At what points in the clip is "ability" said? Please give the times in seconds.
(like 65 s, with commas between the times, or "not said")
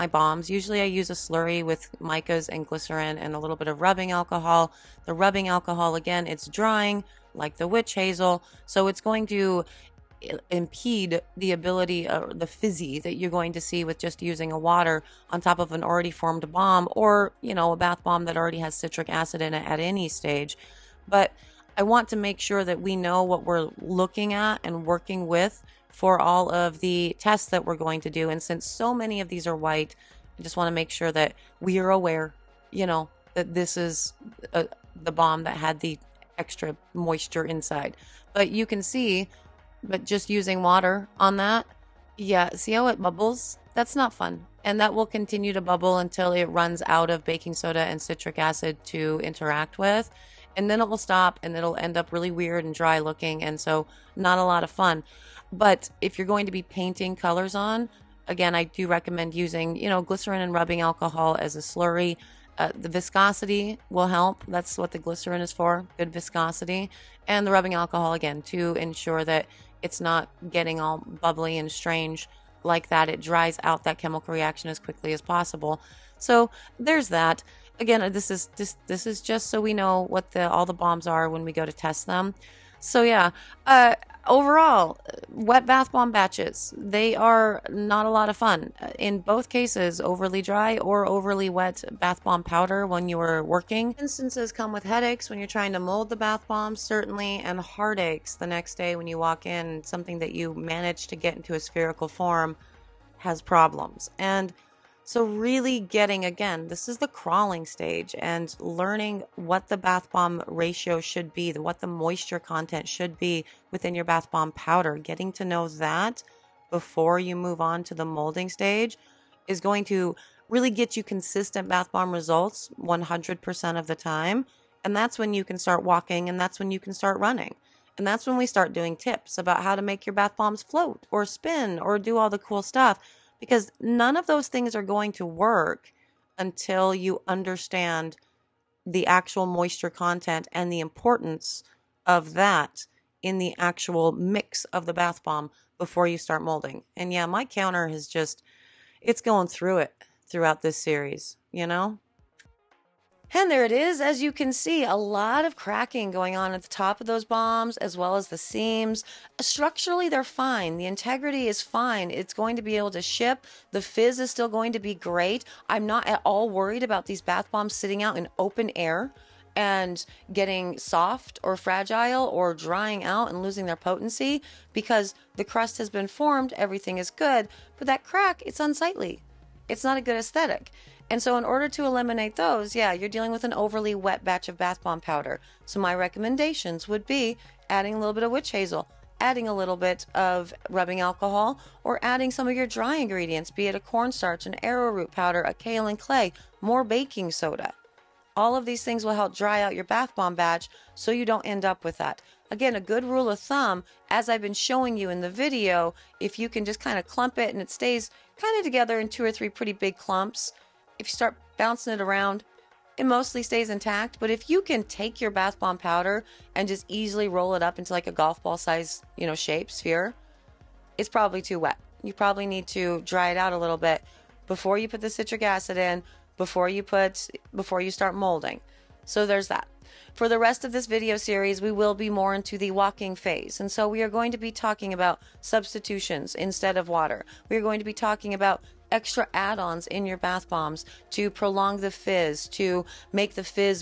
11 s.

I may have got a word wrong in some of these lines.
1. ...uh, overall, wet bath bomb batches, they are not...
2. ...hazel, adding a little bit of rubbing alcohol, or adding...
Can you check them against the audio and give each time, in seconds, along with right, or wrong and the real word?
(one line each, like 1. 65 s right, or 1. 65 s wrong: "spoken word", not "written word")
1. 83 s right
2. 188 s right.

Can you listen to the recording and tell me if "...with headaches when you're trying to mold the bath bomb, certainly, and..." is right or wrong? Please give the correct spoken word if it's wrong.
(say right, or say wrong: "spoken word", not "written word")
right.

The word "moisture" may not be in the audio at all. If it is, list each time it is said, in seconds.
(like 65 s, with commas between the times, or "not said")
36 s, 111 s, 139 s.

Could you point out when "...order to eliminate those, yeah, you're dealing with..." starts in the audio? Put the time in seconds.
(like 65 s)
181 s.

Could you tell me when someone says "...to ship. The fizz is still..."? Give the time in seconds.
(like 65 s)
162 s.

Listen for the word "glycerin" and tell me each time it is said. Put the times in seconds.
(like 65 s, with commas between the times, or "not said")
2 s, 60 s, 64 s.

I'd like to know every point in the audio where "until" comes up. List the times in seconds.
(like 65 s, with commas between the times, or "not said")
45 s, 136 s.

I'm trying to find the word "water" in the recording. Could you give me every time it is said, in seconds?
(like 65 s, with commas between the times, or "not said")
14 s, 40 s, 236 s.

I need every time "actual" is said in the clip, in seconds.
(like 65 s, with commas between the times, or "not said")
139 s, 143 s.